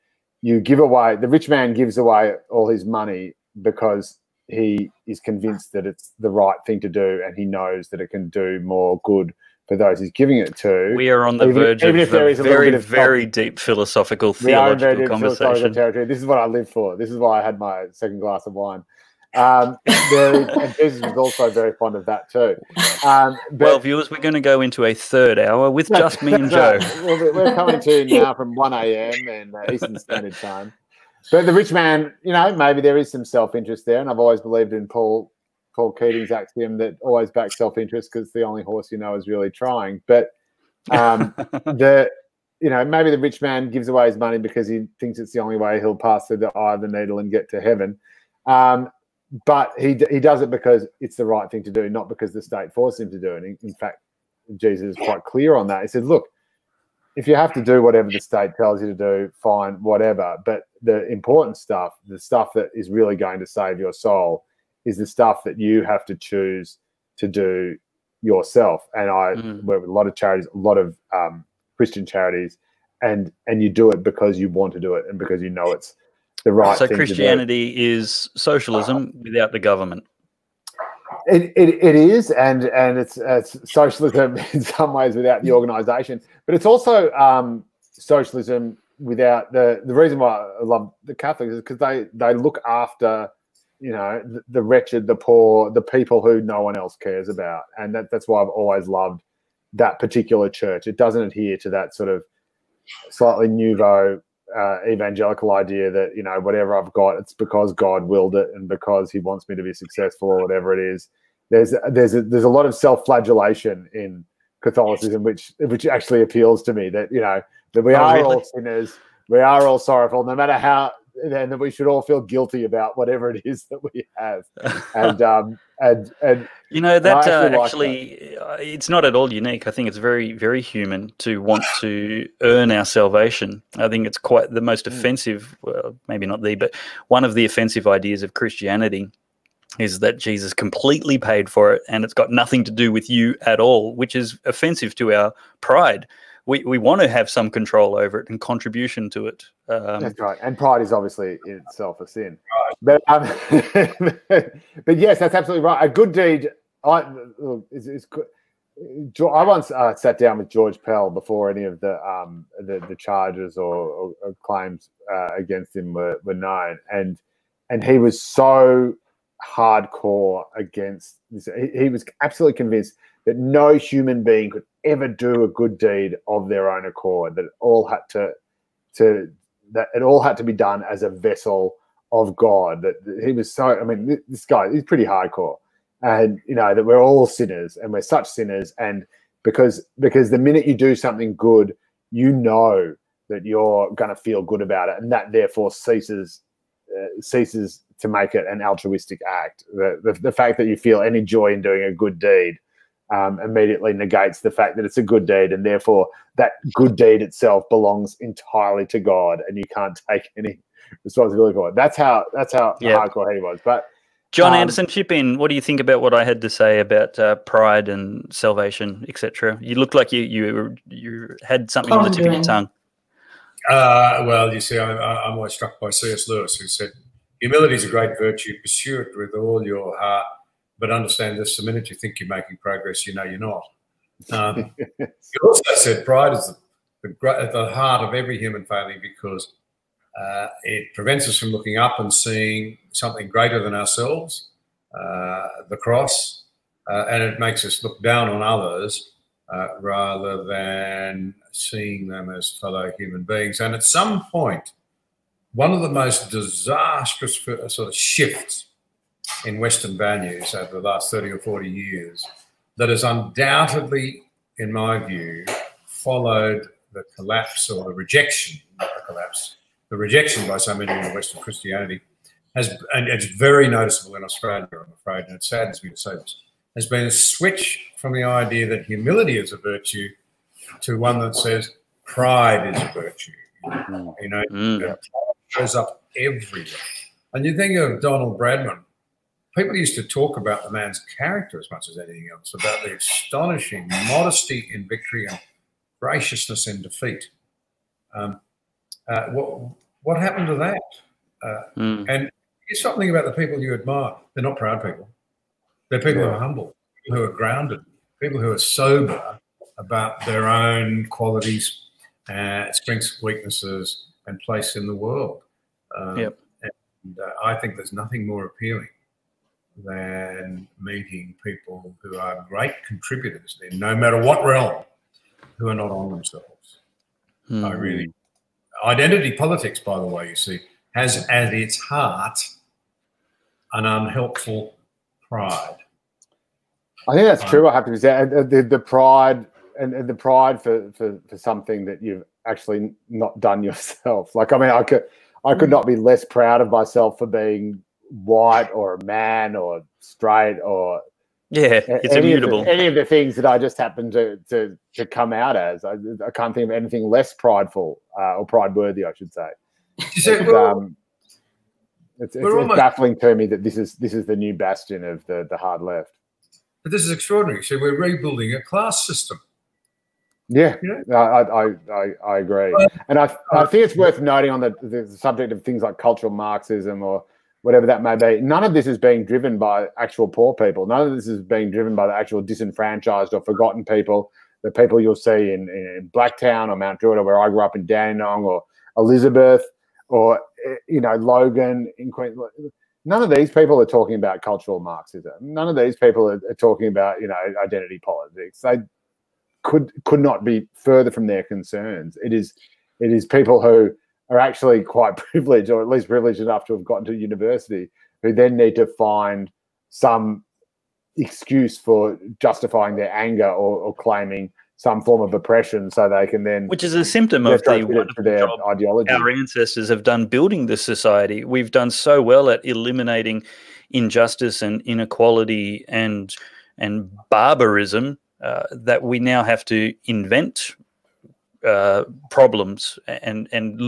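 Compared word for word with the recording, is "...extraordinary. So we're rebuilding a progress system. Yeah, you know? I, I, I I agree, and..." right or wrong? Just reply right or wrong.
wrong.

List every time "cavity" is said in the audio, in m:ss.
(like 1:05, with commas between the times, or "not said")
not said.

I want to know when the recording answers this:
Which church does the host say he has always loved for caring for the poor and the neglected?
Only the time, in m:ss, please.
1:31.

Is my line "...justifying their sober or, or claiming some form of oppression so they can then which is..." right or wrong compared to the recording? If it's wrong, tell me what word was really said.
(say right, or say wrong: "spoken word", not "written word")
wrong: "anger", not "sober".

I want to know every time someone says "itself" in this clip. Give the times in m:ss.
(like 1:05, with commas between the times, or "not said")
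2:31, 3:27.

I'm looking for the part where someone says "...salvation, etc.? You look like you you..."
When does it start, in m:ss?
3:38.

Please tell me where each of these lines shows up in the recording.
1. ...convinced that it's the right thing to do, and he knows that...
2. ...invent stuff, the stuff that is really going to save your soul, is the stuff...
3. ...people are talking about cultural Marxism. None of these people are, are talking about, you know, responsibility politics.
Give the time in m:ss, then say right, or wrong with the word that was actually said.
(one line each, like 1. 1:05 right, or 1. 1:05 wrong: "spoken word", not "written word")
1. 0:05 right
2. 1:01 wrong: "important", not "invent"
3. 6:33 wrong: "identity", not "responsibility".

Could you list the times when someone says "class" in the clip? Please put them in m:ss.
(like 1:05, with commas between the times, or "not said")
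6:08.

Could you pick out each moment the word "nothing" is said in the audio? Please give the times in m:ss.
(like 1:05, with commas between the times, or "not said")
2:22, 5:17.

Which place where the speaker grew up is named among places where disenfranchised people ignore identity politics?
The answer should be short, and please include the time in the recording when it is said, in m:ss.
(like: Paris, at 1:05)
Dandenong, at 6:27.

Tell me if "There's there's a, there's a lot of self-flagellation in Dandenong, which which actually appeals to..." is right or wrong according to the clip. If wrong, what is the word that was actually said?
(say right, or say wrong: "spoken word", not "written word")
wrong: "Catholicism", not "Dandenong".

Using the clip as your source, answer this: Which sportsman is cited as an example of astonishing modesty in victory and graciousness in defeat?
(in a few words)
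Donald Bradman.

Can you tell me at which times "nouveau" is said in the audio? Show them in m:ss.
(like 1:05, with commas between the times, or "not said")
1:43.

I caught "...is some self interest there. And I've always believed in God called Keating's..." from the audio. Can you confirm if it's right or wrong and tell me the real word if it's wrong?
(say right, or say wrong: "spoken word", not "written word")
wrong: "Paul", not "God".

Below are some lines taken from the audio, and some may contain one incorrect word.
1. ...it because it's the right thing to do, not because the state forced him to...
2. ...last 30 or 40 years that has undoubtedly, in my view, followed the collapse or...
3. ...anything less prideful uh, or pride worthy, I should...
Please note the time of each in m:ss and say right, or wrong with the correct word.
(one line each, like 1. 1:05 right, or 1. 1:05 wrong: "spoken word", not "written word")
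1. 0:50 right
2. 4:20 right
3. 5:56 right.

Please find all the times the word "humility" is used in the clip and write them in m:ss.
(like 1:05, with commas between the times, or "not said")
3:47, 4:38.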